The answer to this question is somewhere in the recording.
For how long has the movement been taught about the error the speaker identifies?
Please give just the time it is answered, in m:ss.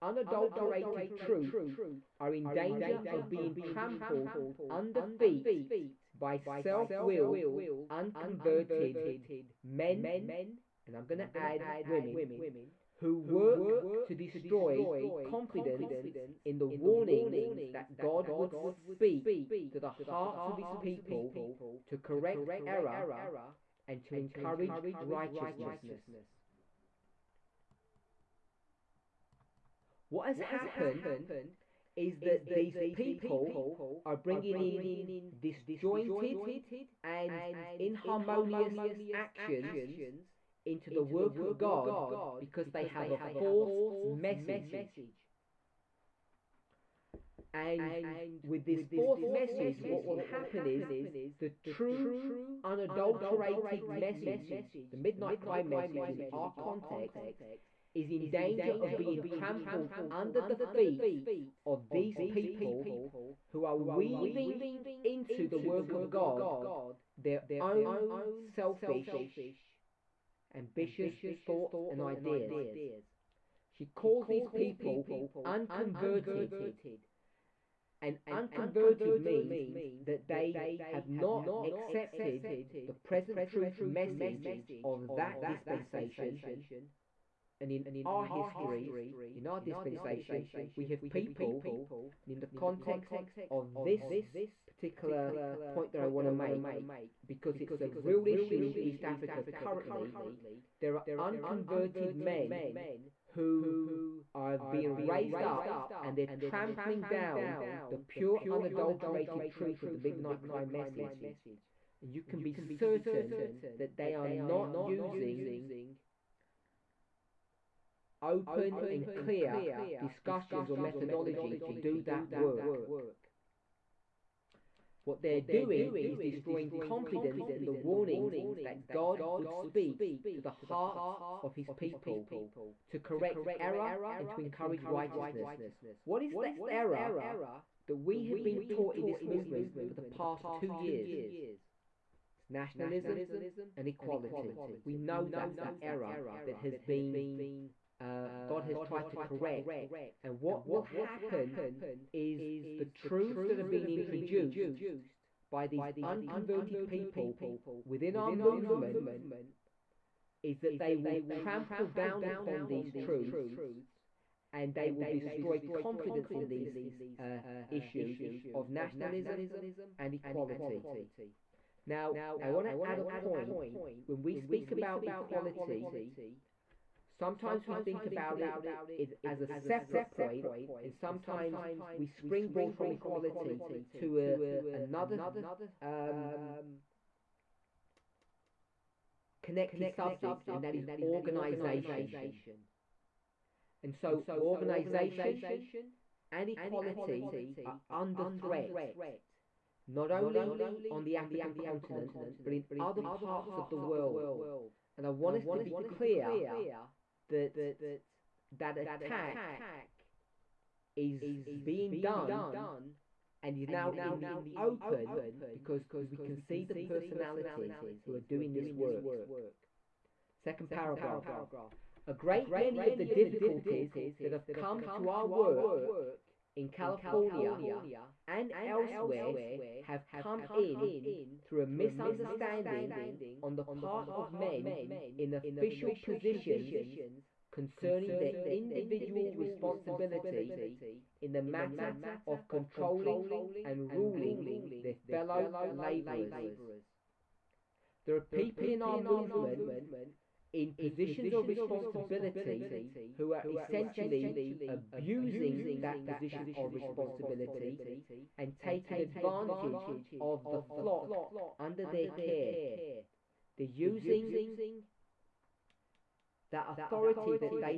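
2:20.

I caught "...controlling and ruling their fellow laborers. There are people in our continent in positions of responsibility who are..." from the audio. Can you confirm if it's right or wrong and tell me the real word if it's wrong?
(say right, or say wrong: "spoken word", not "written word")
wrong: "movement", not "continent".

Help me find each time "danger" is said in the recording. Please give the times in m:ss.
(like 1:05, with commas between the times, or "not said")
0:02, 0:58.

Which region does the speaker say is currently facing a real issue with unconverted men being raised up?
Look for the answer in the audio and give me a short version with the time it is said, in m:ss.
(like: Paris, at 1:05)
East Africa, at 1:38.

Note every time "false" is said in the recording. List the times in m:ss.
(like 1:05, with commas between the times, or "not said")
0:43, 0:48.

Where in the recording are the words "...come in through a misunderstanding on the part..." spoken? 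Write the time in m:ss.
3:50.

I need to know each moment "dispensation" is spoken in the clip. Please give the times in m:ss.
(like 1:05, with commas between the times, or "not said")
1:25, 1:29.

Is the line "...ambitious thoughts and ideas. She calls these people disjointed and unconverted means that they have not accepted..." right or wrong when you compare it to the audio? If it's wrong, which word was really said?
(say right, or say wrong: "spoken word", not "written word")
wrong: "unconverted", not "disjointed".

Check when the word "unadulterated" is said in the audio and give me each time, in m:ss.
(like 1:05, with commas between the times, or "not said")
0:00, 0:52, 1:48.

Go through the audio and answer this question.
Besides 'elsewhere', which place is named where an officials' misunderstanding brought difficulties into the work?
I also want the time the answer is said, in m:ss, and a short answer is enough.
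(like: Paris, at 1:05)
California, at 3:46.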